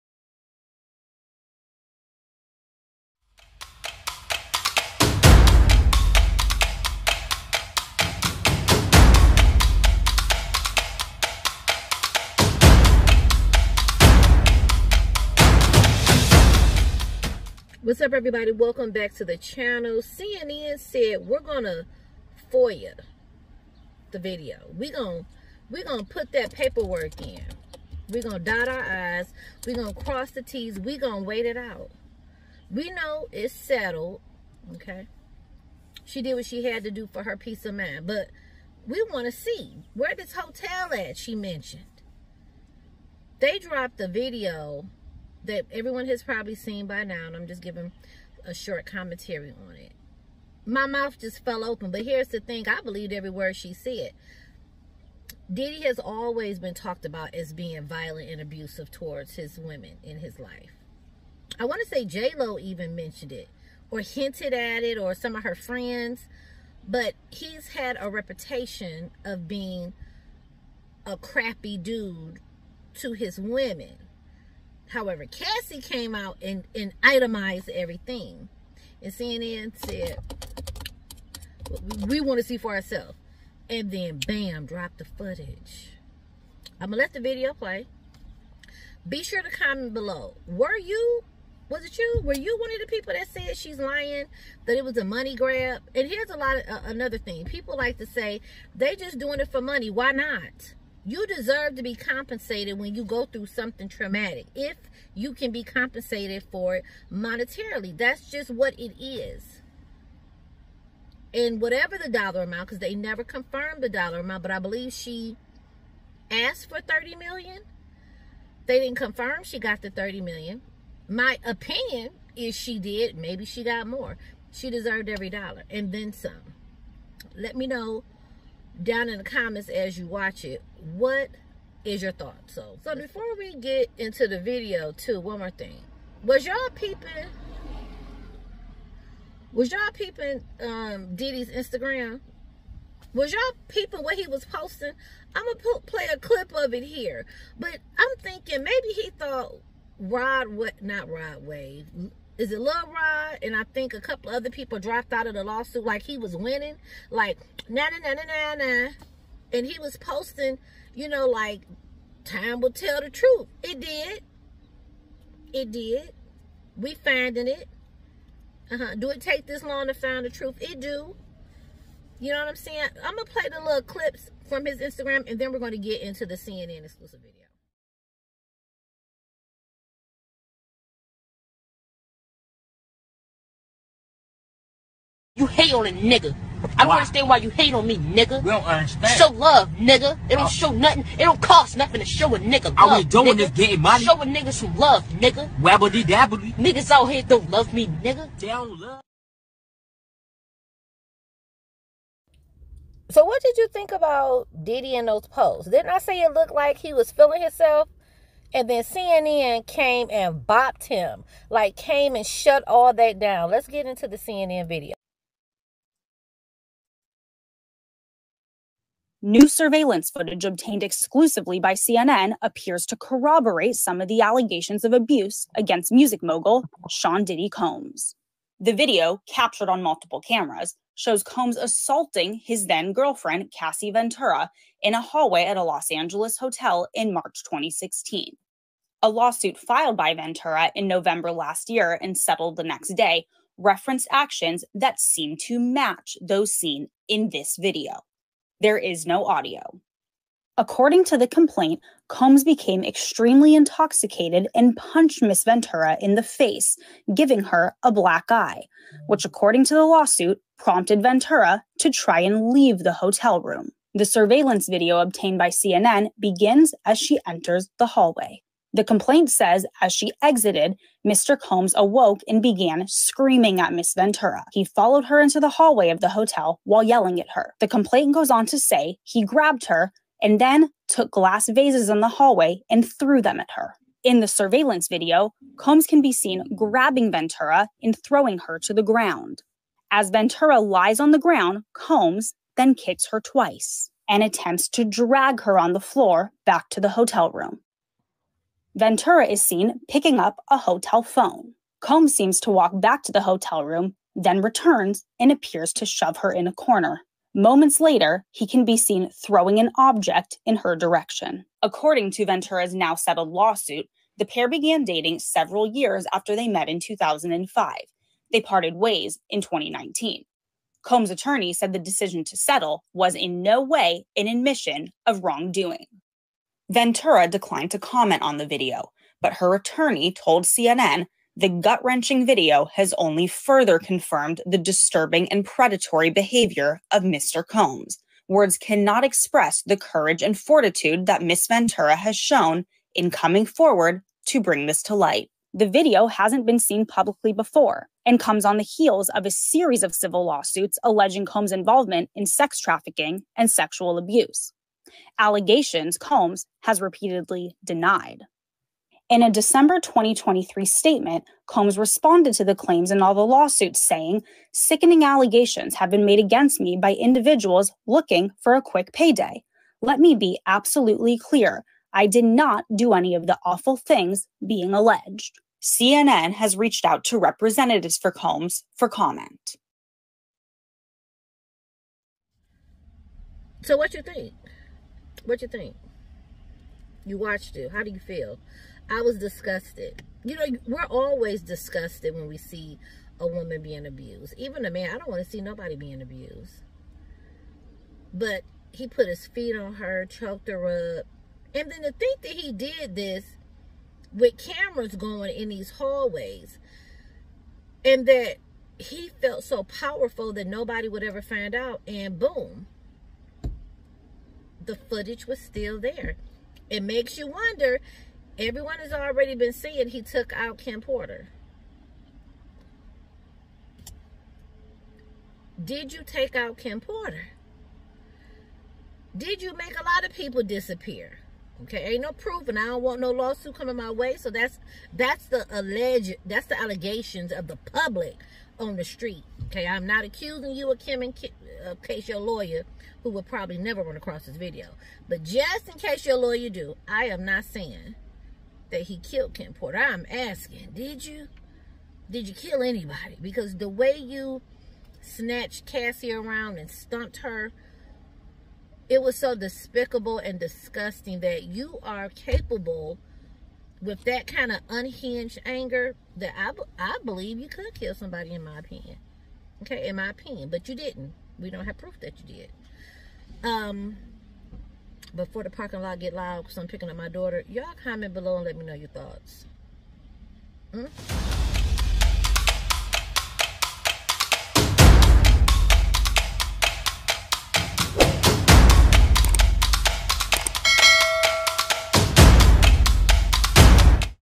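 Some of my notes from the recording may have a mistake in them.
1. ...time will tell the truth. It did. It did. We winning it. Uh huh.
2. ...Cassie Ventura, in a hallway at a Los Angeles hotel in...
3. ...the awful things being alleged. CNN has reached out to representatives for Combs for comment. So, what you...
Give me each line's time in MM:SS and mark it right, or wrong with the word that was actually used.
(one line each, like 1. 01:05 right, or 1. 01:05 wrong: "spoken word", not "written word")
1. 02:42 wrong: "finding", not "winning"
2. 03:53 right
3. 06:13 right.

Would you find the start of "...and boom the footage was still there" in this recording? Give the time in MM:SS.
06:51.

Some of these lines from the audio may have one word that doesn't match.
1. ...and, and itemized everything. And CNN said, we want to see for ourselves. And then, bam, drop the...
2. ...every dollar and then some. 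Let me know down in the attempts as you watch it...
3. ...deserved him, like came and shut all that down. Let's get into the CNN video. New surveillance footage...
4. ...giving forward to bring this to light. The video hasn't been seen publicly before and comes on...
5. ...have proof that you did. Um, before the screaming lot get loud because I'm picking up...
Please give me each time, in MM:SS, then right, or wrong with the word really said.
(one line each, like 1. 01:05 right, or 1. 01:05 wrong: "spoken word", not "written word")
1. 01:16 right
2. 02:05 wrong: "comments", not "attempts"
3. 03:30 wrong: "bopped", not "deserved"
4. 05:43 wrong: "coming", not "giving"
5. 07:51 wrong: "parking", not "screaming".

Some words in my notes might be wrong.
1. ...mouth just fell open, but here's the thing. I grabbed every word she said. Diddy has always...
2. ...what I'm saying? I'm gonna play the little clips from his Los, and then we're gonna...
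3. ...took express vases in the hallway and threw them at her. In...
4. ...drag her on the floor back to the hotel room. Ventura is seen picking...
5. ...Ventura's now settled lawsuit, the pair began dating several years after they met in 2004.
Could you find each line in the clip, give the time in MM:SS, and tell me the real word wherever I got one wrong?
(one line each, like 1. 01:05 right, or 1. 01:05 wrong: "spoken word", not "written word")
1. 00:50 wrong: "believed", not "grabbed"
2. 02:52 wrong: "Instagram", not "Los"
3. 04:40 wrong: "glass", not "express"
4. 04:54 right
5. 05:12 wrong: "2005", not "2004".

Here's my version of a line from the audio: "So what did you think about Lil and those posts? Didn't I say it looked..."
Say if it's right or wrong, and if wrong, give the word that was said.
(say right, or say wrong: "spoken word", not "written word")
wrong: "Diddy", not "Lil".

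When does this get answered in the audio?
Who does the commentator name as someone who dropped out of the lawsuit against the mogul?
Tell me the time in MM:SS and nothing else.
02:32.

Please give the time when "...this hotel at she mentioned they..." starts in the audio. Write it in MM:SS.
00:40.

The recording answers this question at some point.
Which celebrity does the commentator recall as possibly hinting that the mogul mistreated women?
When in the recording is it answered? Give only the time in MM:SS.
01:02.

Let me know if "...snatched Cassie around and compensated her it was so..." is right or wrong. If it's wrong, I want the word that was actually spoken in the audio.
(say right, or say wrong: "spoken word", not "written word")
wrong: "stumped", not "compensated".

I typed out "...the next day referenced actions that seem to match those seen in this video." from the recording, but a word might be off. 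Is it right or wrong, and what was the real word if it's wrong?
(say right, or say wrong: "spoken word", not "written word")
right.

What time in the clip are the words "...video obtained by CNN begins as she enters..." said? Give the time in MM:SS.
04:24.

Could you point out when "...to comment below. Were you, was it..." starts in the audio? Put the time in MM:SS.
01:29.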